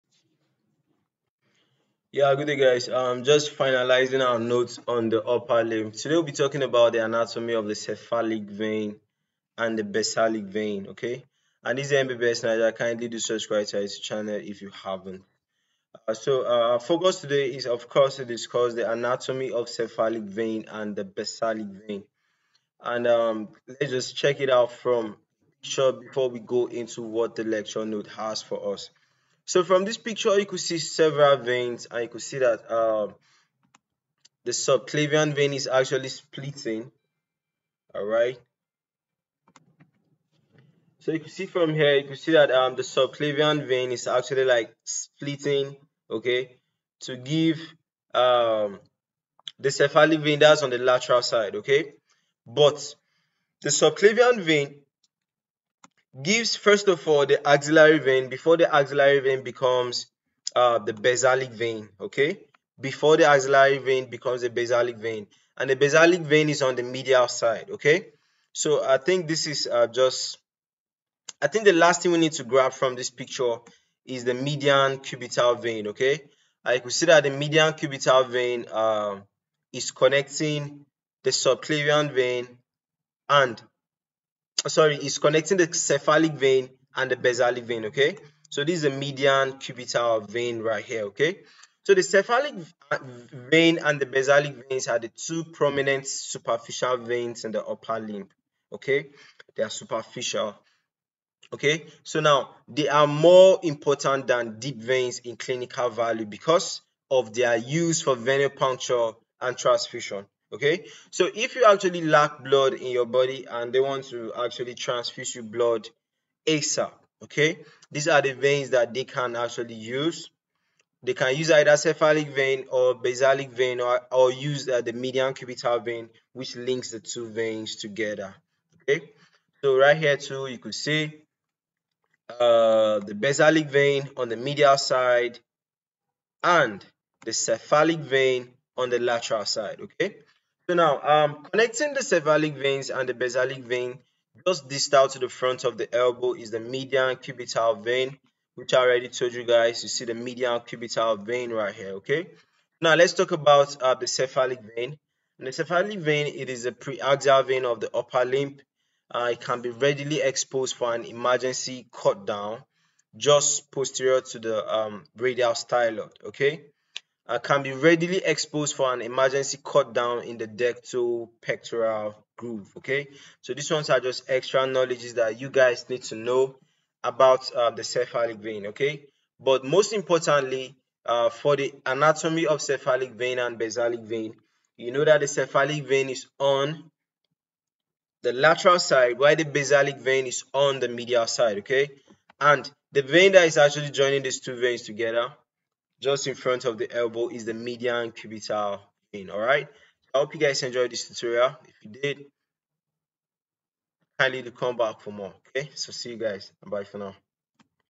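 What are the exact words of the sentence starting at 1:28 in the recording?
So this is the median cubital vein right here, okay?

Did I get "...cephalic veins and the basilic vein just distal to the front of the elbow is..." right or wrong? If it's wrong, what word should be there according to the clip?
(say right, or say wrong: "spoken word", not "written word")
right.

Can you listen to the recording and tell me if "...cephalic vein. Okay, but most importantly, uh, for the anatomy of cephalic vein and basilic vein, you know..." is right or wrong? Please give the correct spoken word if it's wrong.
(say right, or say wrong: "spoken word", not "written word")
right.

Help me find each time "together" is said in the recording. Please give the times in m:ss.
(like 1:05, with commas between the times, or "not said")
2:07, 3:14.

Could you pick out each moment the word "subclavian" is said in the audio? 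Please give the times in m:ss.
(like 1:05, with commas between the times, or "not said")
0:34, 0:42, 0:53, 1:21.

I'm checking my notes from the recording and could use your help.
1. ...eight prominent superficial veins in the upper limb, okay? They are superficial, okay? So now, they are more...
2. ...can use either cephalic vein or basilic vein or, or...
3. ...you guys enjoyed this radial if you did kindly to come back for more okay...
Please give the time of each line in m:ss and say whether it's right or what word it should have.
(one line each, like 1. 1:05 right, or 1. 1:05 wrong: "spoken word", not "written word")
1. 1:35 wrong: "two", not "eight"
2. 2:01 right
3. 3:20 wrong: "tutorial", not "radial".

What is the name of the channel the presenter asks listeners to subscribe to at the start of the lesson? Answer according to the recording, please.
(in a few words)
MBBS Naija.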